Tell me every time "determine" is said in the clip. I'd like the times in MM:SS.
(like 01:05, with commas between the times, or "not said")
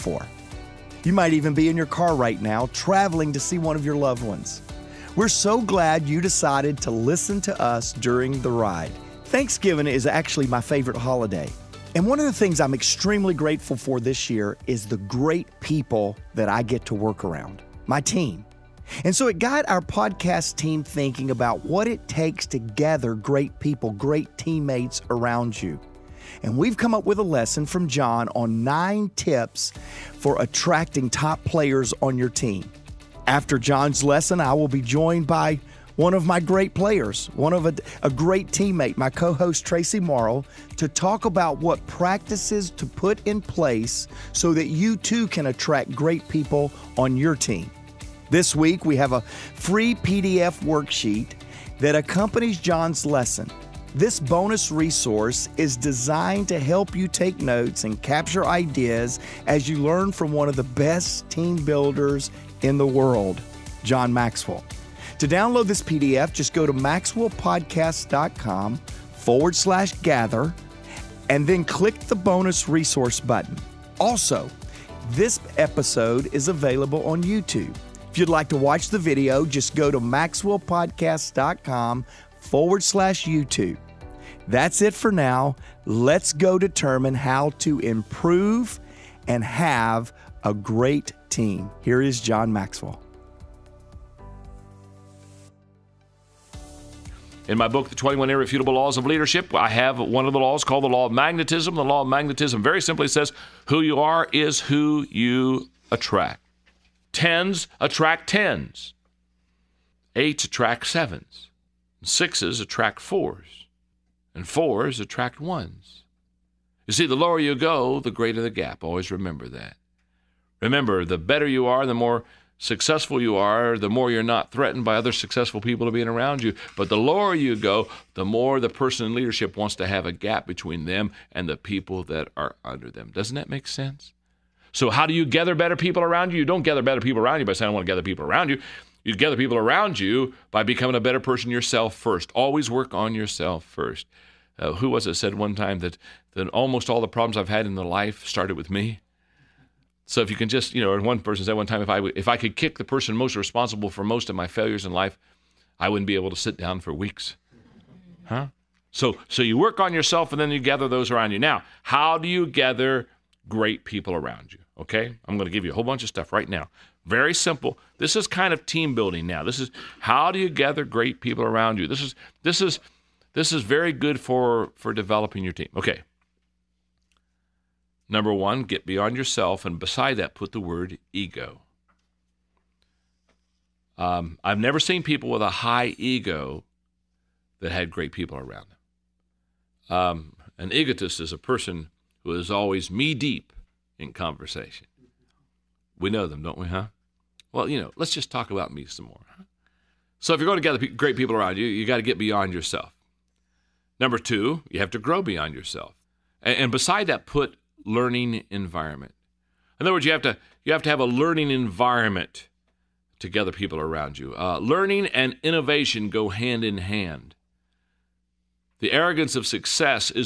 01:26.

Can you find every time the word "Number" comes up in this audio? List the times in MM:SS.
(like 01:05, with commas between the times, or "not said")
02:58, 03:23.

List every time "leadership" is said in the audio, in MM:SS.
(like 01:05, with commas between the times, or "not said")
01:39, 02:09.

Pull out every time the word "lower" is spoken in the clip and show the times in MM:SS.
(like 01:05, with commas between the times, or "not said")
01:57, 02:06.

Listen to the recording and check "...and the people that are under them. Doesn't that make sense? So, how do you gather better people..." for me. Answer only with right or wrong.
right.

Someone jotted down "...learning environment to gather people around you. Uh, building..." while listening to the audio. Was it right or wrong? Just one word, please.
wrong.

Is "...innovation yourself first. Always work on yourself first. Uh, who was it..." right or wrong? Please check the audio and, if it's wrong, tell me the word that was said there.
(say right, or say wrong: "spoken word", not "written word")
wrong: "person", not "innovation".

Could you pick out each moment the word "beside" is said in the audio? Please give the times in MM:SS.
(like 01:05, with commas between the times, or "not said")
02:59, 03:26.